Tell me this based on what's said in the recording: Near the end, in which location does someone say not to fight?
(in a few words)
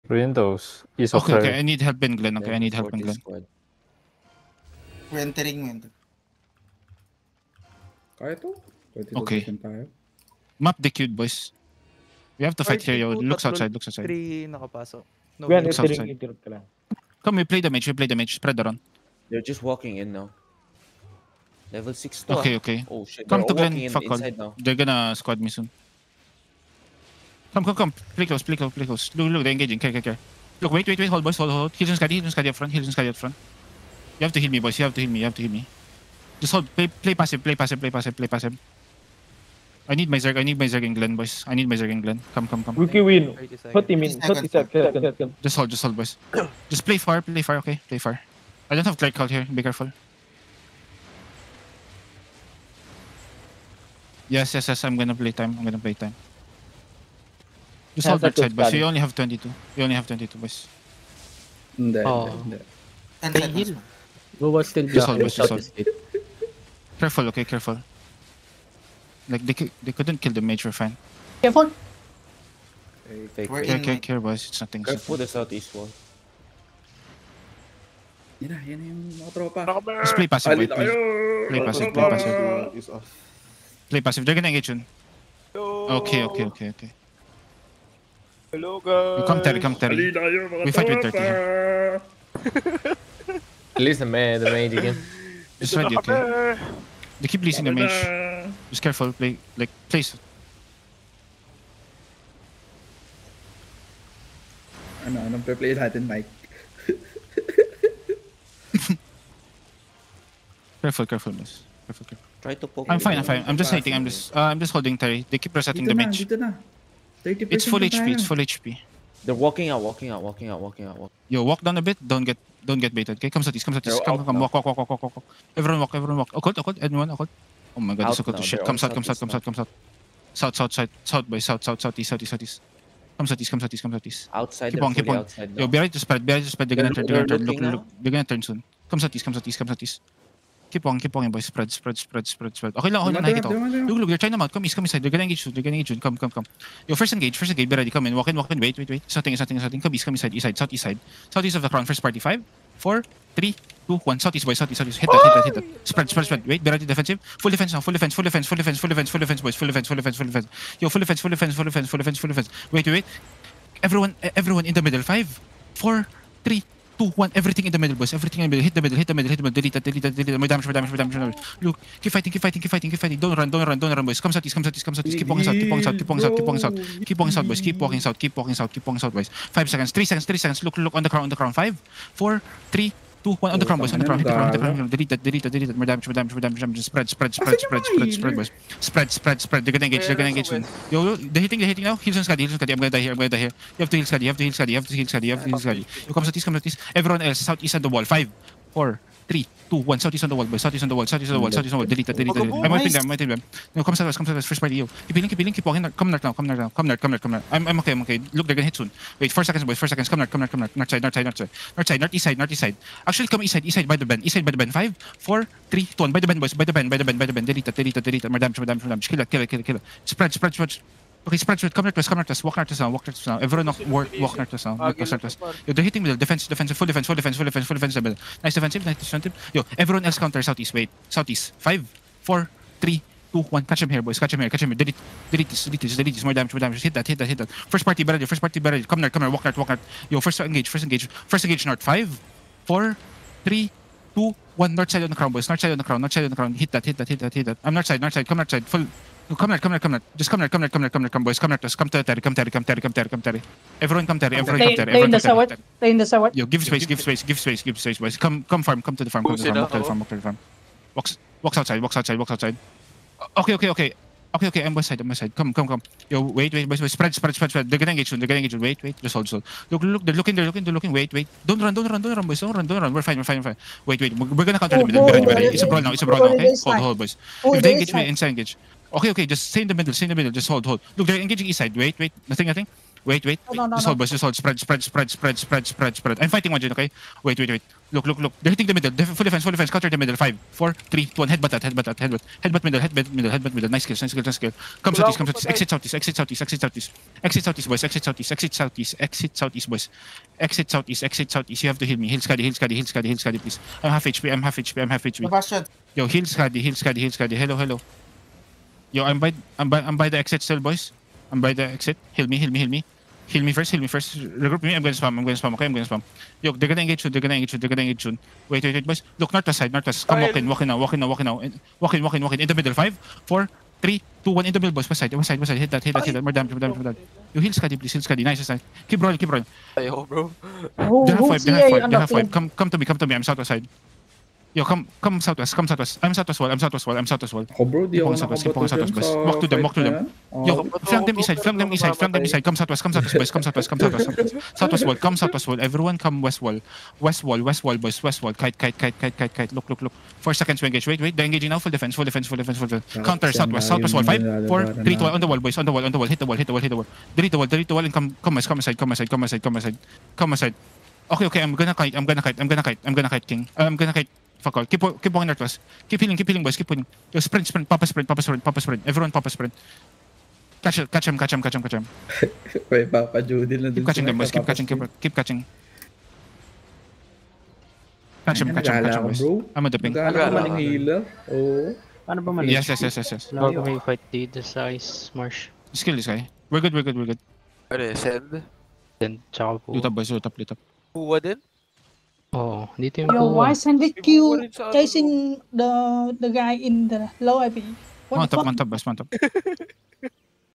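Ice marsh.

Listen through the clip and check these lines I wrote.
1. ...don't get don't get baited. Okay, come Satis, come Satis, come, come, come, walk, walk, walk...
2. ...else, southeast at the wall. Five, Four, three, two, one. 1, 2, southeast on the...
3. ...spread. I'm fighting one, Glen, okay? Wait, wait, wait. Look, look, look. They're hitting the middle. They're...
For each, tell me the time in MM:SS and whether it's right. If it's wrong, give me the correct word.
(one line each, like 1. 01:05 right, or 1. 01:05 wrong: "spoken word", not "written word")
1. 02:02 right
2. 03:17 wrong: "3", not "1"
3. 04:45 wrong: "Jin", not "Glen".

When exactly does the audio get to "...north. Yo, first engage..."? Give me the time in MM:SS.
03:59.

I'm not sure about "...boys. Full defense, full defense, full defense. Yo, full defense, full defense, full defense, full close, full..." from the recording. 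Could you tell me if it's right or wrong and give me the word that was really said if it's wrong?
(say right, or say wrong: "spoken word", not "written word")
wrong: "defense", not "close".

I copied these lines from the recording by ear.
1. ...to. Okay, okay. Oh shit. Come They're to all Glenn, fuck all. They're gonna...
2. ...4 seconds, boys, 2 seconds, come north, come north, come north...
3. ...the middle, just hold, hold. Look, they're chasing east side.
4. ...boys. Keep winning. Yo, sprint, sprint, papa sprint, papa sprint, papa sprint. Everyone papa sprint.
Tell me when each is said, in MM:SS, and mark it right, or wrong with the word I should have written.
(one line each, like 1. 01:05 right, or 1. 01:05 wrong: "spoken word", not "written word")
1. 00:22 right
2. 03:29 wrong: "4", not "2"
3. 04:40 wrong: "engaging", not "chasing"
4. 06:06 right.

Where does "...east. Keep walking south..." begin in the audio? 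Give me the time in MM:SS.
02:55.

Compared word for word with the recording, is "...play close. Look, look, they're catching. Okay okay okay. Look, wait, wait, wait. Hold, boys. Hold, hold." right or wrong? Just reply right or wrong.
wrong.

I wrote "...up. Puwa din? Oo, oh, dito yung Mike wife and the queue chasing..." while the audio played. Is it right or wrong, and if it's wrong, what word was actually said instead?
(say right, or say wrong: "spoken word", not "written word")
wrong: "Your", not "Mike".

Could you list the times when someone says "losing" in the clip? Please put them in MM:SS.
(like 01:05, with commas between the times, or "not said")
01:37.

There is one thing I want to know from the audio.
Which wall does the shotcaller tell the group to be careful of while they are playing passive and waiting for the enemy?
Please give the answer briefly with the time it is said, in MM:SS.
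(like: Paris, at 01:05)
The southeast wall, at 01:15.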